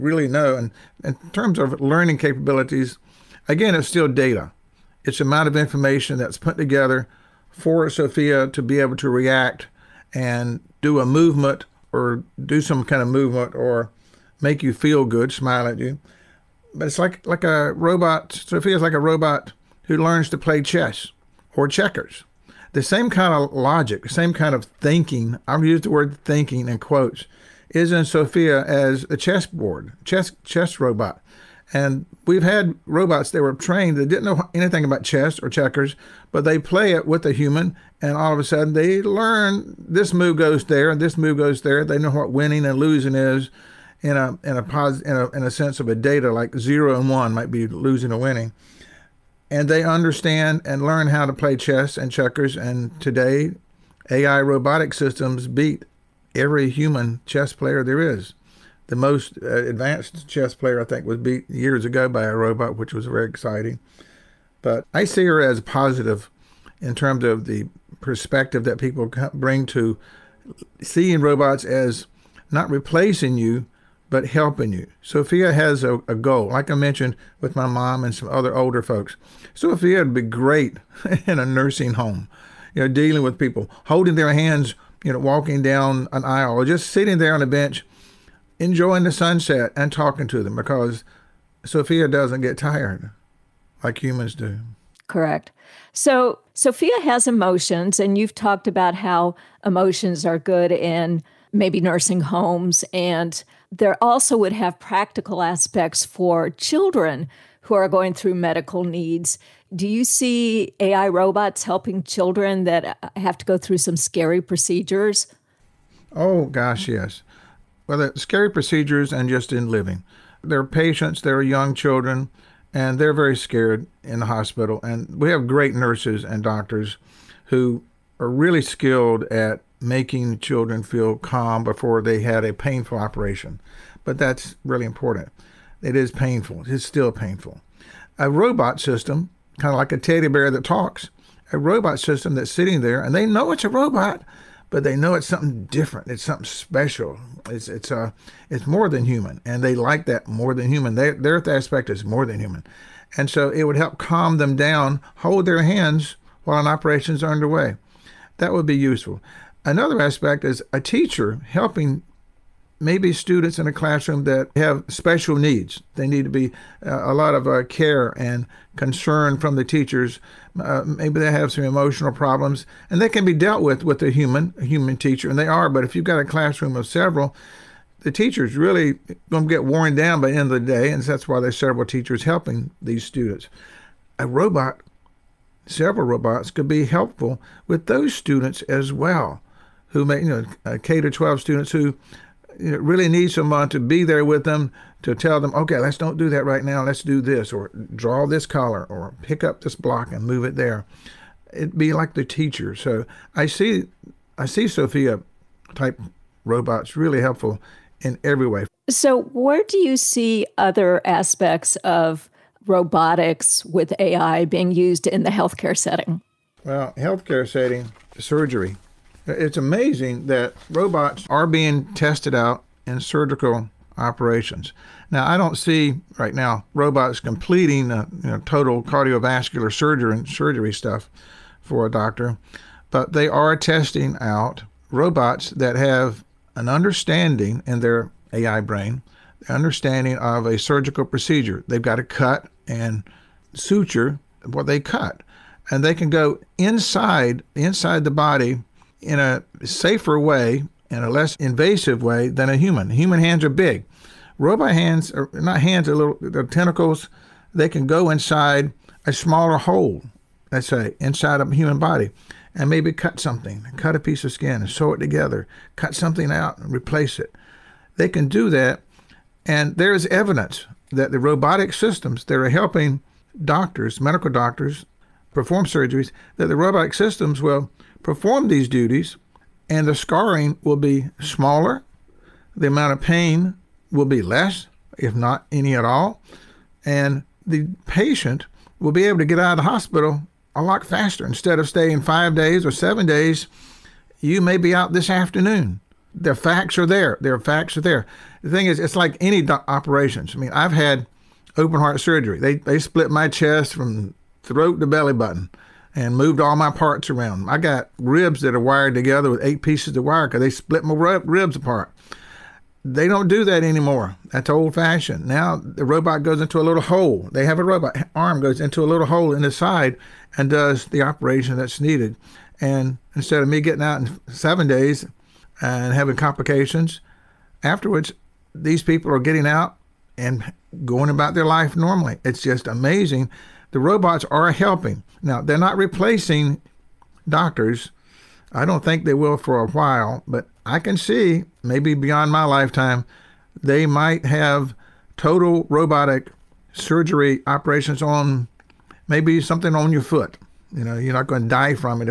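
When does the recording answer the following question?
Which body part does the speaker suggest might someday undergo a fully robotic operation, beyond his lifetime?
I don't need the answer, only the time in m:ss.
5:49.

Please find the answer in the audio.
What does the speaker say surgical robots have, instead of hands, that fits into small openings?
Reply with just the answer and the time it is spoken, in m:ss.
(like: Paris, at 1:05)
Tentacles, at 4:16.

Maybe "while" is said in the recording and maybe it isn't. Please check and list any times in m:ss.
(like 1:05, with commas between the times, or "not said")
2:36, 5:39.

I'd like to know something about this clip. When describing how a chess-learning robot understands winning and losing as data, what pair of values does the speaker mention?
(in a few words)
0 and 1.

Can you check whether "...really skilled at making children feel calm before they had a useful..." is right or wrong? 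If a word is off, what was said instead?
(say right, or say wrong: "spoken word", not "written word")
wrong: "painful", not "useful".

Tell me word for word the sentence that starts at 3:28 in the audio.
So where do you see other aspects of robotics with AI being used in the healthcare setting?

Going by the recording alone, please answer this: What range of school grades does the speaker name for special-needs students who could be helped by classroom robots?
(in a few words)
K to 12.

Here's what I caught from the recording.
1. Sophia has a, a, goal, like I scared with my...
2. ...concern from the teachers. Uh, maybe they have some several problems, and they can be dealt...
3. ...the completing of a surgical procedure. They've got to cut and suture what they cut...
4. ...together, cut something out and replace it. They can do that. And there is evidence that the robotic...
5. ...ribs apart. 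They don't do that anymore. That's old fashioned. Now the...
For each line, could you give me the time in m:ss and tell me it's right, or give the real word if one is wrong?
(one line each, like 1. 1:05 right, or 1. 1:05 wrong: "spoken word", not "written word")
1. 1:15 wrong: "mentioned", not "scared"
2. 2:48 wrong: "emotional", not "several"
3. 3:59 wrong: "understanding", not "completing"
4. 4:24 right
5. 5:11 right.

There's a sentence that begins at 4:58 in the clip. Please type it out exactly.
The thing is, it's like any do- operations.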